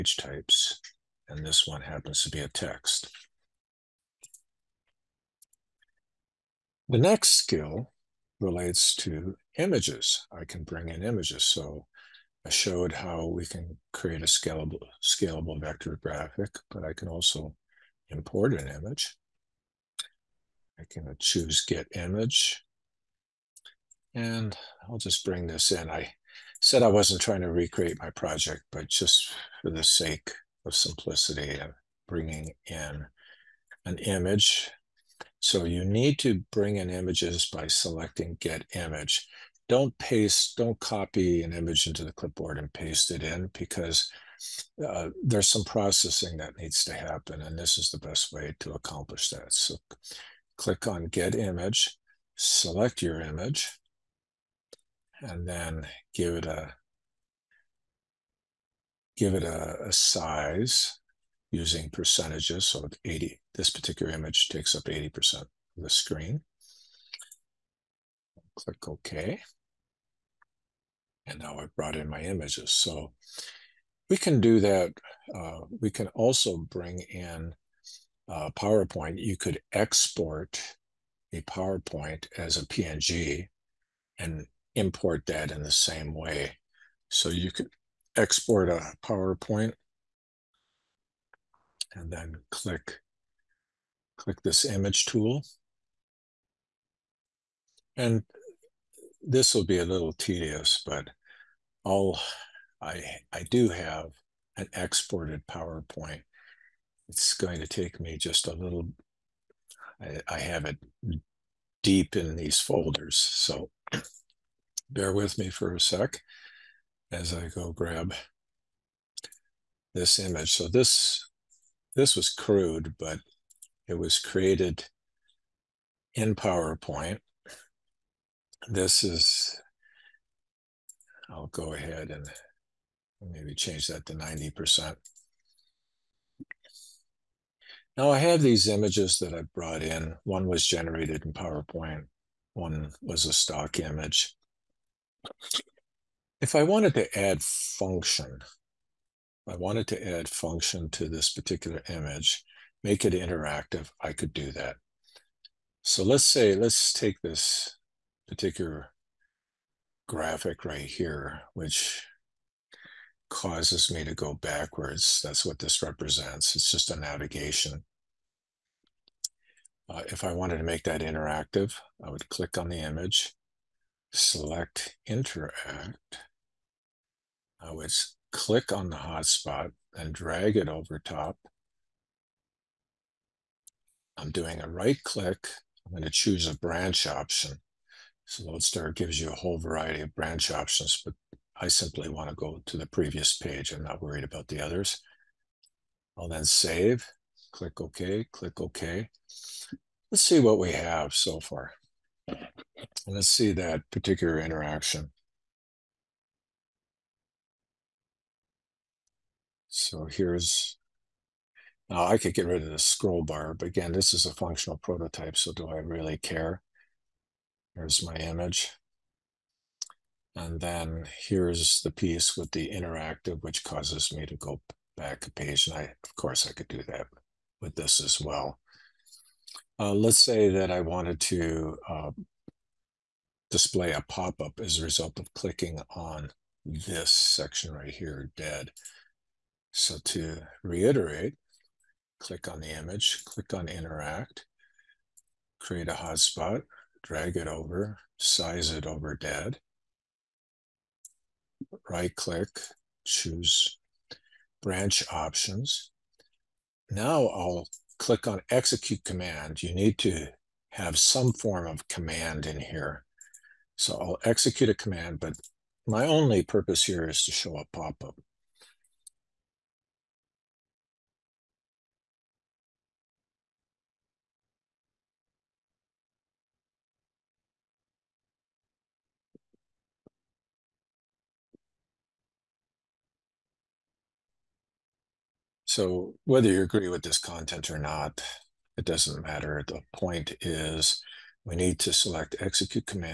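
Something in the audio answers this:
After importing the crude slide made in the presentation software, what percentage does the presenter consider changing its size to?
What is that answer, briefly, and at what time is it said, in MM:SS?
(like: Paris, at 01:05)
90%, at 02:14.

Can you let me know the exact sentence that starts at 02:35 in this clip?
So let's say, let's take this particular graphic right here, which causes me to go backwards.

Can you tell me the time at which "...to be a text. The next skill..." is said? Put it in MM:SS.
00:02.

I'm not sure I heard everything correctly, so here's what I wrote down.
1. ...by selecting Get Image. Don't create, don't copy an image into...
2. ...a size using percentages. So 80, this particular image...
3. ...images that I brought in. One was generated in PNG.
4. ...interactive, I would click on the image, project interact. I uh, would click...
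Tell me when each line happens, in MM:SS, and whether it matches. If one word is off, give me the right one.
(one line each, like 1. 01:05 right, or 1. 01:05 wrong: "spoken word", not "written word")
1. 00:37 wrong: "paste", not "create"
2. 00:59 right
3. 02:18 wrong: "PowerPoint", not "PNG"
4. 02:51 wrong: "select", not "project".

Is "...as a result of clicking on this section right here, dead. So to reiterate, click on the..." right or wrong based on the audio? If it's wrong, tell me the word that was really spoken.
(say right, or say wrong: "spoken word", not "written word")
right.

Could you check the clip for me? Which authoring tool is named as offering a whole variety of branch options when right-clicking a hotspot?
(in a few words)
LodeStar.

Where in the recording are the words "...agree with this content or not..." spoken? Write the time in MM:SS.
04:46.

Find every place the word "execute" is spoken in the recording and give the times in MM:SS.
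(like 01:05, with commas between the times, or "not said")
04:18, 04:24, 04:52.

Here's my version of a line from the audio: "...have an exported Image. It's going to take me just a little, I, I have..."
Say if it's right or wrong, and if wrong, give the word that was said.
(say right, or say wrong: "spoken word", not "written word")
wrong: "PowerPoint", not "Image".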